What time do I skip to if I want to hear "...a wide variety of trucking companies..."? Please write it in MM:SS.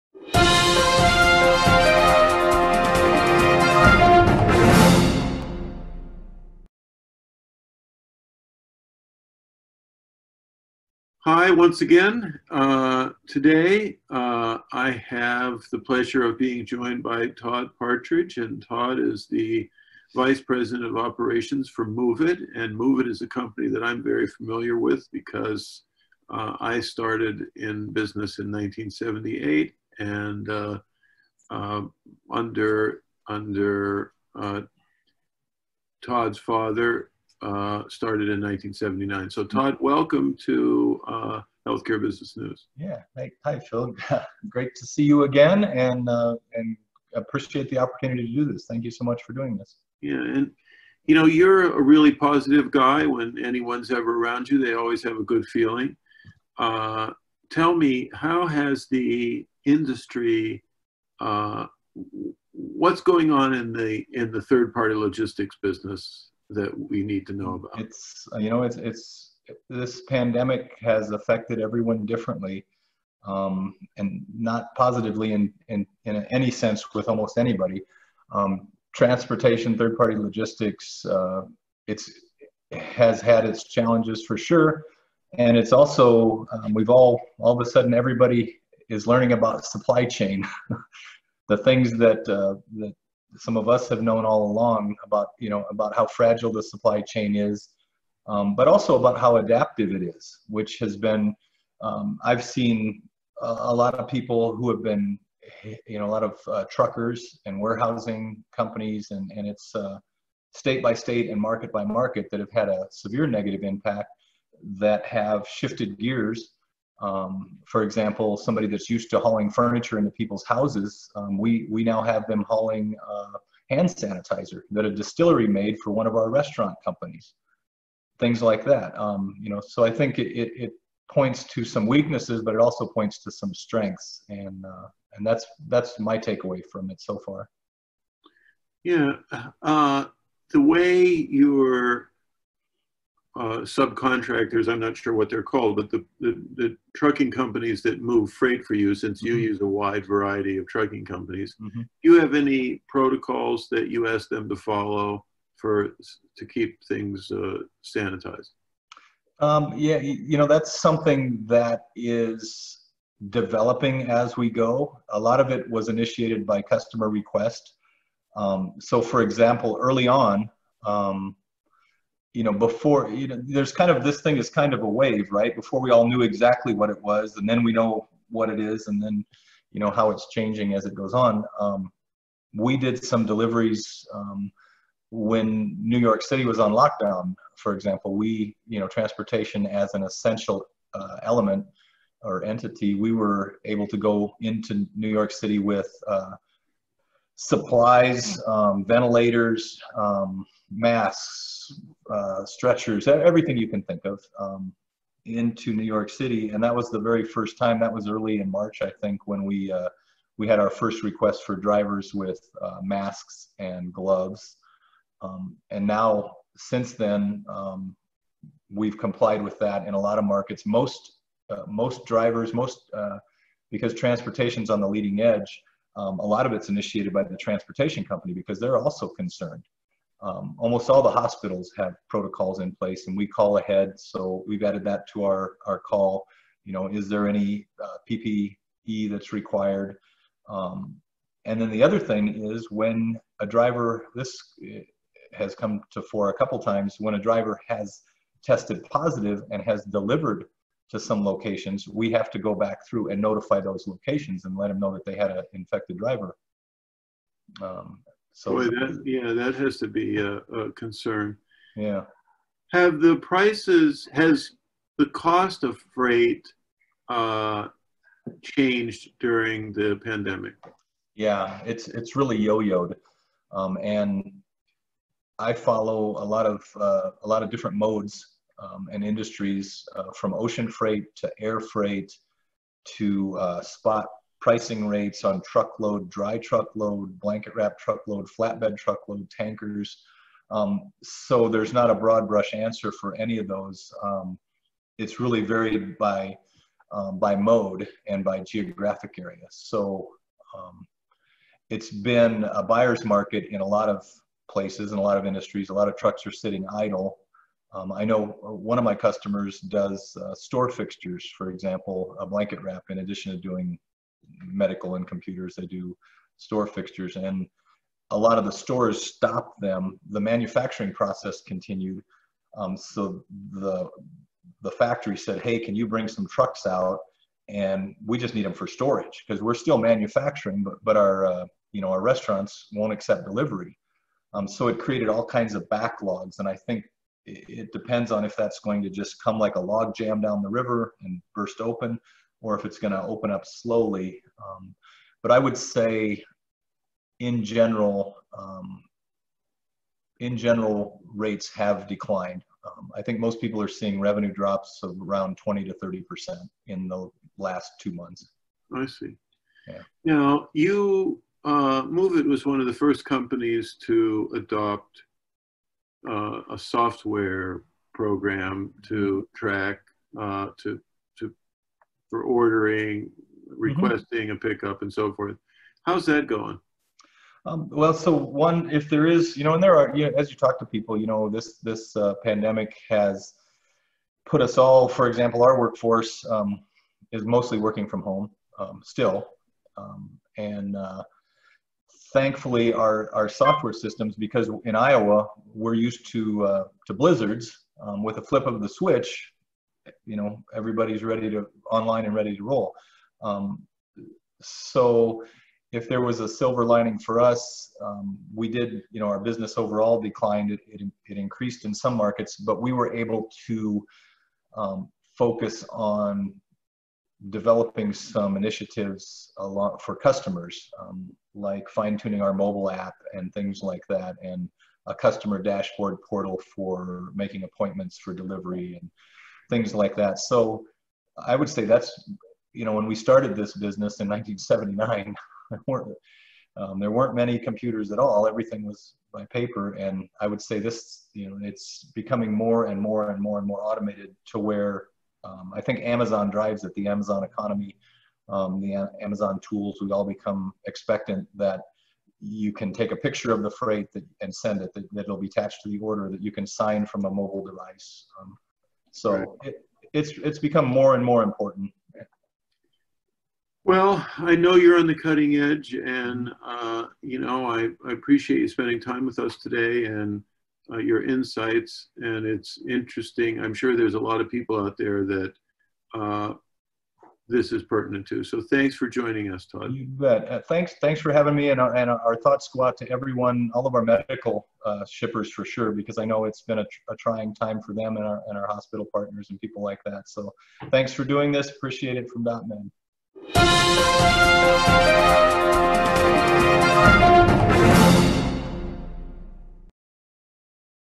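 02:29.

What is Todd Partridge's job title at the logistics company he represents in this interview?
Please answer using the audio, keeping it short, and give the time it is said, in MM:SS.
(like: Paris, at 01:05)
Vice President of Operations, at 00:20.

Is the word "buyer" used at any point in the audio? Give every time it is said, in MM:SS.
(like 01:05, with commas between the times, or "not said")
05:02.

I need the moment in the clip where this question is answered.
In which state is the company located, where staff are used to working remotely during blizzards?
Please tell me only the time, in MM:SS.
06:34.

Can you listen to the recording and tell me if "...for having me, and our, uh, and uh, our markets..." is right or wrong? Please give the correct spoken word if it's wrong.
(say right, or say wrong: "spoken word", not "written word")
wrong: "thoughts", not "markets".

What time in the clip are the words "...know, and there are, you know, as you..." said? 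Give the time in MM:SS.
06:19.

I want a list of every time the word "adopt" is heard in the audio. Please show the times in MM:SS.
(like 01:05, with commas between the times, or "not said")
06:04.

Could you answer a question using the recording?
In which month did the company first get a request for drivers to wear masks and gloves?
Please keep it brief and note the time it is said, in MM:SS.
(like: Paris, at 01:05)
March, at 03:28.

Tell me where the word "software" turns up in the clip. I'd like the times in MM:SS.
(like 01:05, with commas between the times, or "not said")
06:06, 06:33.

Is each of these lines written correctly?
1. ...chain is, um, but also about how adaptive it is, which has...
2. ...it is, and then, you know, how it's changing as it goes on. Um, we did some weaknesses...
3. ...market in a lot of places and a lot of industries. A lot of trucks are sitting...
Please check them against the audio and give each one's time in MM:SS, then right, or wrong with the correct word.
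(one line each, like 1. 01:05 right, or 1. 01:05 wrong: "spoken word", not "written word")
1. 01:37 right
2. 02:58 wrong: "deliveries", not "weaknesses"
3. 05:03 right.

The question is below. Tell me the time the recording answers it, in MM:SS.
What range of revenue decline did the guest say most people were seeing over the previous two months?
05:55.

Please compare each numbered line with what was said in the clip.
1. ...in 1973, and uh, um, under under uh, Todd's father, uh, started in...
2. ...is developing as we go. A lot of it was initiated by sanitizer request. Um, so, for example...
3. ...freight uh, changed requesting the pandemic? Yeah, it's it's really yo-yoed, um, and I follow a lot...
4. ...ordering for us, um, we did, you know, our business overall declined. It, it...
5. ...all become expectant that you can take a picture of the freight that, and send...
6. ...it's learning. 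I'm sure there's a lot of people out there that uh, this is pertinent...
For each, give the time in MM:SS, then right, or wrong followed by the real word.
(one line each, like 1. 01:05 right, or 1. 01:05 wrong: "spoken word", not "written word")
1. 00:28 wrong: "1978", not "1973"
2. 02:41 wrong: "customer", not "sanitizer"
3. 04:25 wrong: "during", not "requesting"
4. 06:46 wrong: "lining", not "ordering"
5. 07:29 right
6. 07:52 wrong: "interesting", not "learning".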